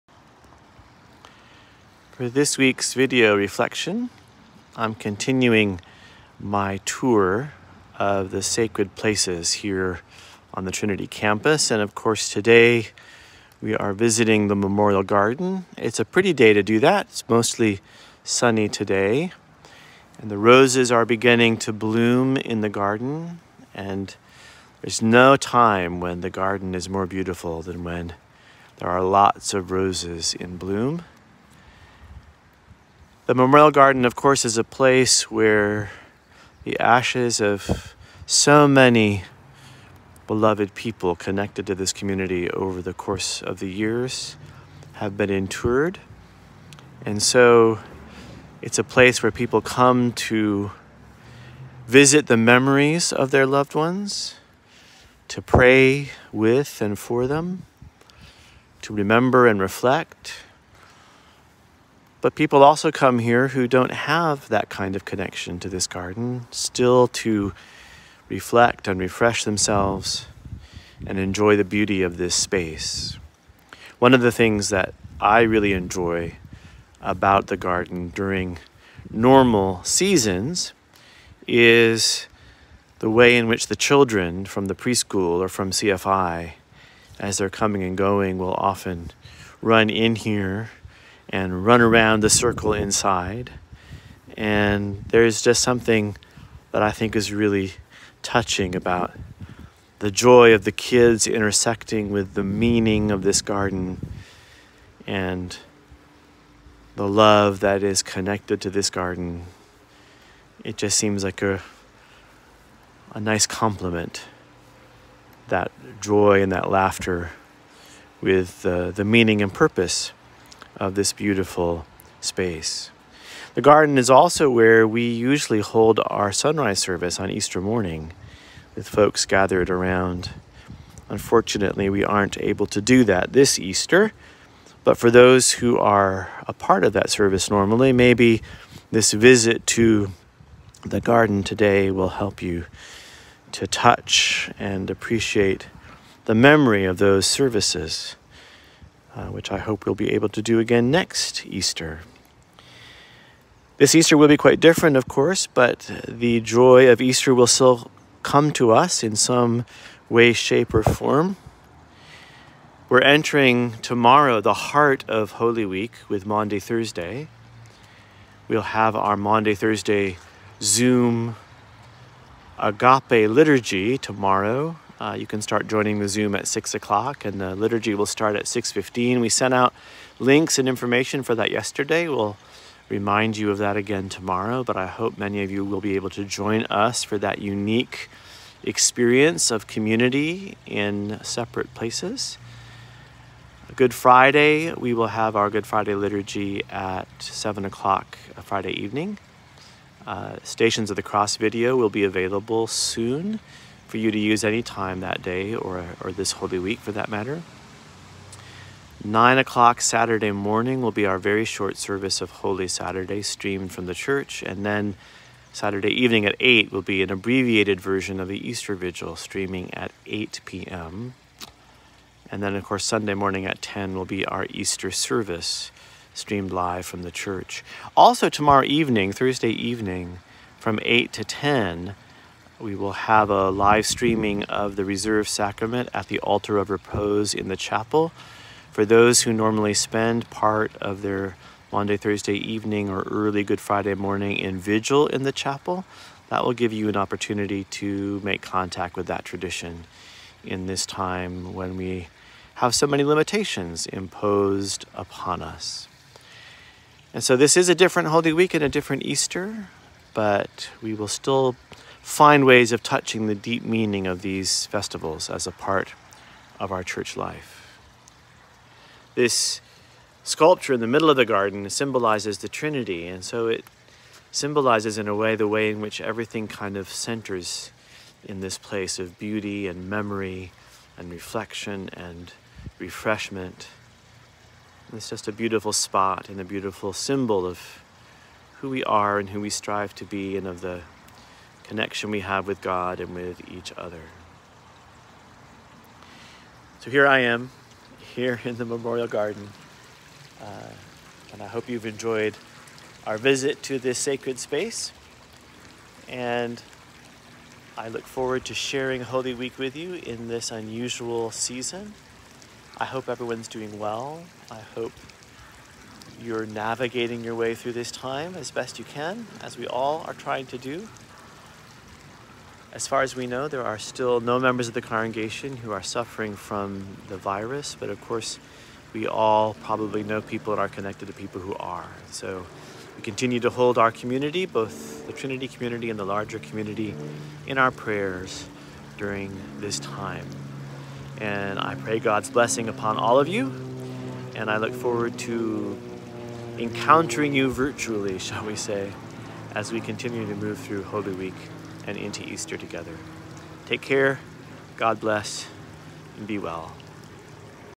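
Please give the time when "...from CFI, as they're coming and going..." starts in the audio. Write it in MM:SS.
01:25.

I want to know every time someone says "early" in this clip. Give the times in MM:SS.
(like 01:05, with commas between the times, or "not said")
04:03.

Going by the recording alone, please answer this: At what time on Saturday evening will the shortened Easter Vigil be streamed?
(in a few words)
8 p.m.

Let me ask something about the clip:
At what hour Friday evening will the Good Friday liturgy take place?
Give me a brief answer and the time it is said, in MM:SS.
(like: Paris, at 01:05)
7 o'clock, at 03:17.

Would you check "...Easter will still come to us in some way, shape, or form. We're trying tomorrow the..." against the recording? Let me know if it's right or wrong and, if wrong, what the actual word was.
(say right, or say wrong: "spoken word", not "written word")
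wrong: "entering", not "trying".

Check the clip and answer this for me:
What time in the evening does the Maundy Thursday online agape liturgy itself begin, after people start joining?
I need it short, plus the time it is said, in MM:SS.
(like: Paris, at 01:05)
6:15, at 02:58.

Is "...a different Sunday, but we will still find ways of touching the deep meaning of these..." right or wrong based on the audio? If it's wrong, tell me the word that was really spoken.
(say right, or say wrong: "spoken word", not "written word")
wrong: "Easter", not "Sunday".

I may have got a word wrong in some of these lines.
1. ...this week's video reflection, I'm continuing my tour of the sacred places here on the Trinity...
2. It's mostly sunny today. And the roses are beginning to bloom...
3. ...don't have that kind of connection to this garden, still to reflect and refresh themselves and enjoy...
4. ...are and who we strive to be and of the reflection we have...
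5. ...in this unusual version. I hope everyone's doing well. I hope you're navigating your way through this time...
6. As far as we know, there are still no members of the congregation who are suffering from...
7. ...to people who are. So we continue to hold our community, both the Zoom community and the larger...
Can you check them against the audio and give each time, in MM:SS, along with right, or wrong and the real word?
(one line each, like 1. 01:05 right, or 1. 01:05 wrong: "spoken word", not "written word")
1. 00:02 right
2. 00:17 right
3. 01:03 right
4. 04:48 wrong: "connection", not "reflection"
5. 05:09 wrong: "season", not "version"
6. 05:22 right
7. 05:31 wrong: "Trinity", not "Zoom".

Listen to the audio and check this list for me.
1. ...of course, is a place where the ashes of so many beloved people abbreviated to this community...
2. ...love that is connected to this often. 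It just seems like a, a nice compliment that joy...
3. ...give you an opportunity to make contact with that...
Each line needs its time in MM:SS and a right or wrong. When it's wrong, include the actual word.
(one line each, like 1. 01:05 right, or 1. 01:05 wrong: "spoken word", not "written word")
1. 00:34 wrong: "connected", not "abbreviated"
2. 01:47 wrong: "garden", not "often"
3. 04:06 right.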